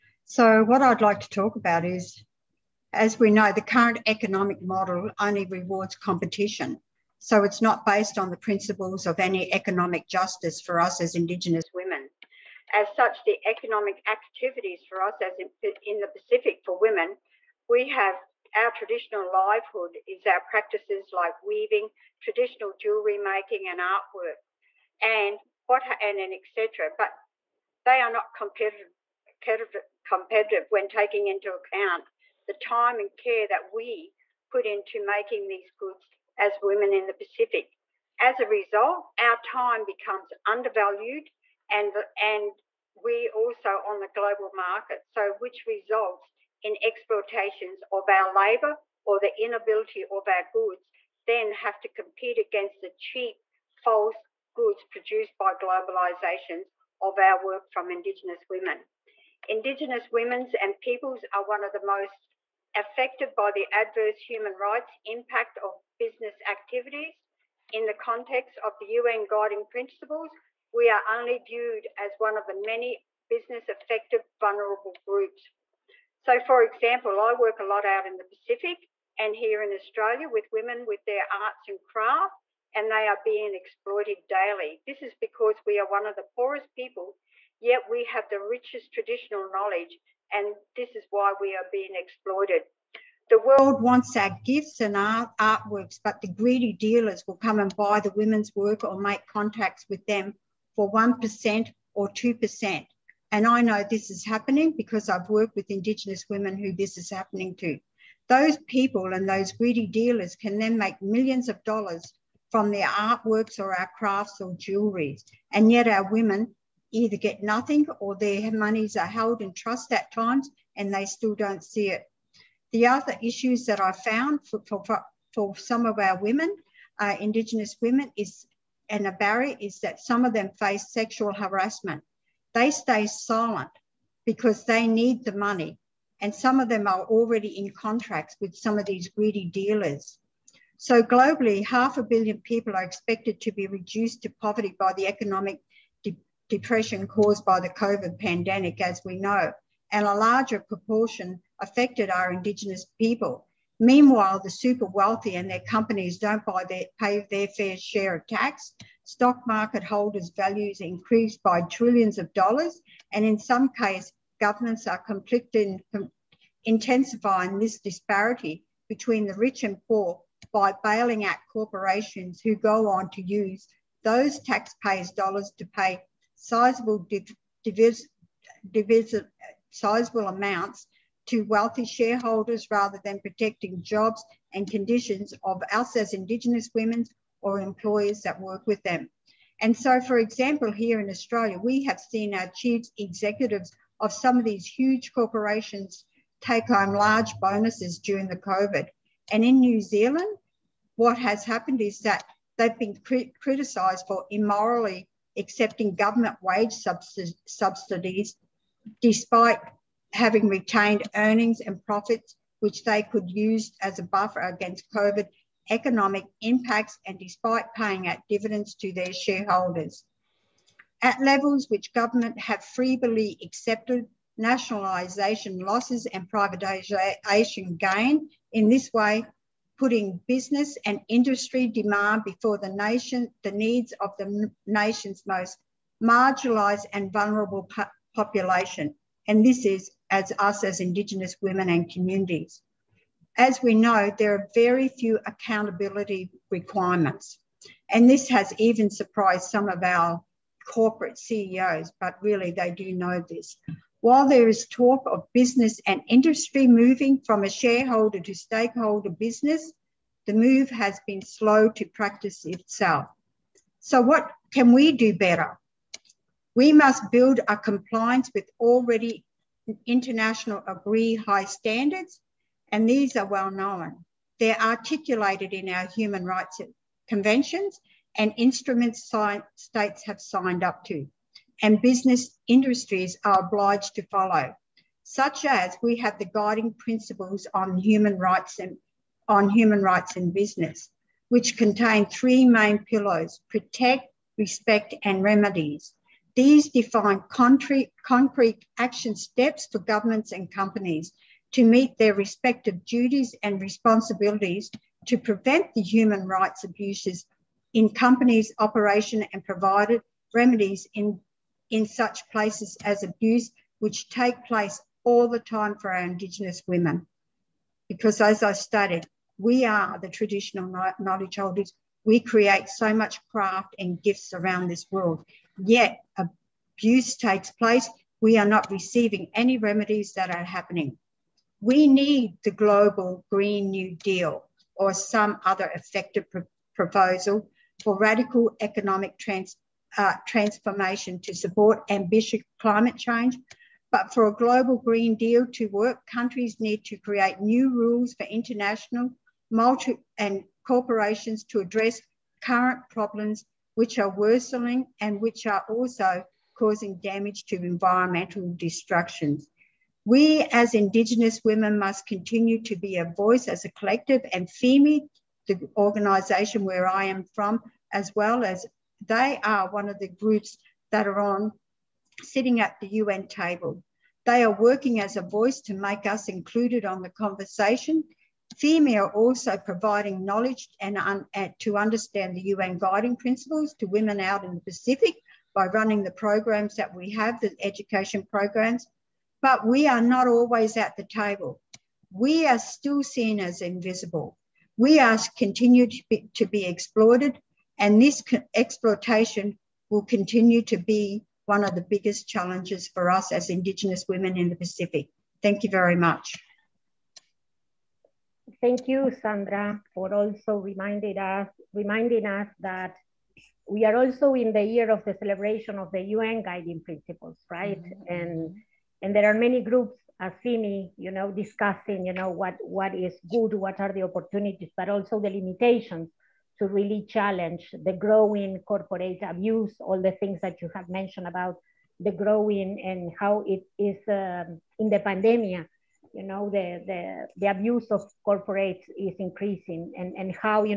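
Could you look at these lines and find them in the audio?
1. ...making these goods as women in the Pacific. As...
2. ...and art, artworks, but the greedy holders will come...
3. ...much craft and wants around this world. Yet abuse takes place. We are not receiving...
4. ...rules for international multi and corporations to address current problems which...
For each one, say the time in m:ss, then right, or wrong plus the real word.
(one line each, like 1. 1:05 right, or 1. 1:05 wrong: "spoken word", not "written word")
1. 0:35 right
2. 1:34 wrong: "dealers", not "holders"
3. 5:22 wrong: "gifts", not "wants"
4. 5:47 right.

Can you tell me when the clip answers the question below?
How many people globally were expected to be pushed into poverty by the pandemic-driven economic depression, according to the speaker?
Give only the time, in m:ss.
2:21.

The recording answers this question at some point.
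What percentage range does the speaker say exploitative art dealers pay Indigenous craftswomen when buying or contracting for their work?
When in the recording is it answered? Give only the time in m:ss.
1:40.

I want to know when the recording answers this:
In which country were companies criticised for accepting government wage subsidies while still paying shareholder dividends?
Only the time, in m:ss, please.
3:19.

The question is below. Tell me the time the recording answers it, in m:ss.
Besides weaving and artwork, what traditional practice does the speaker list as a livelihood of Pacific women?
0:22.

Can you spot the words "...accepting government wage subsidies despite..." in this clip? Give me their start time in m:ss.
3:25.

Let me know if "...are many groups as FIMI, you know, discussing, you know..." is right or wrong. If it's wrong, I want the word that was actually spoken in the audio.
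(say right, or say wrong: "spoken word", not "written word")
right.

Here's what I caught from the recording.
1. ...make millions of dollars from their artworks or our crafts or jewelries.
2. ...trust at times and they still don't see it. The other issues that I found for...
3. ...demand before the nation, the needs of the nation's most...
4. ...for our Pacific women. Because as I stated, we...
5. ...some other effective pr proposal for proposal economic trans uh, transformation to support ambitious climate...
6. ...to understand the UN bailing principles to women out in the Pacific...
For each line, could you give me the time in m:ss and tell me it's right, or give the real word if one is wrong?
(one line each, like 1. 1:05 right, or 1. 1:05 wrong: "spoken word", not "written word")
1. 1:50 right
2. 1:59 right
3. 3:51 right
4. 5:15 wrong: "Indigenous", not "Pacific"
5. 5:34 wrong: "radical", not "proposal"
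6. 6:21 wrong: "guiding", not "bailing".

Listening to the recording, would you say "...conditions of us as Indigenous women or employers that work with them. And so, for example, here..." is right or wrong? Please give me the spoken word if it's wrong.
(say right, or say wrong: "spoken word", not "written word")
right.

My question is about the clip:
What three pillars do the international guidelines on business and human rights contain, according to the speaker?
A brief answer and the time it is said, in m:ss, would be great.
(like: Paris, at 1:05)
protect, respect, and remedies, at 4:53.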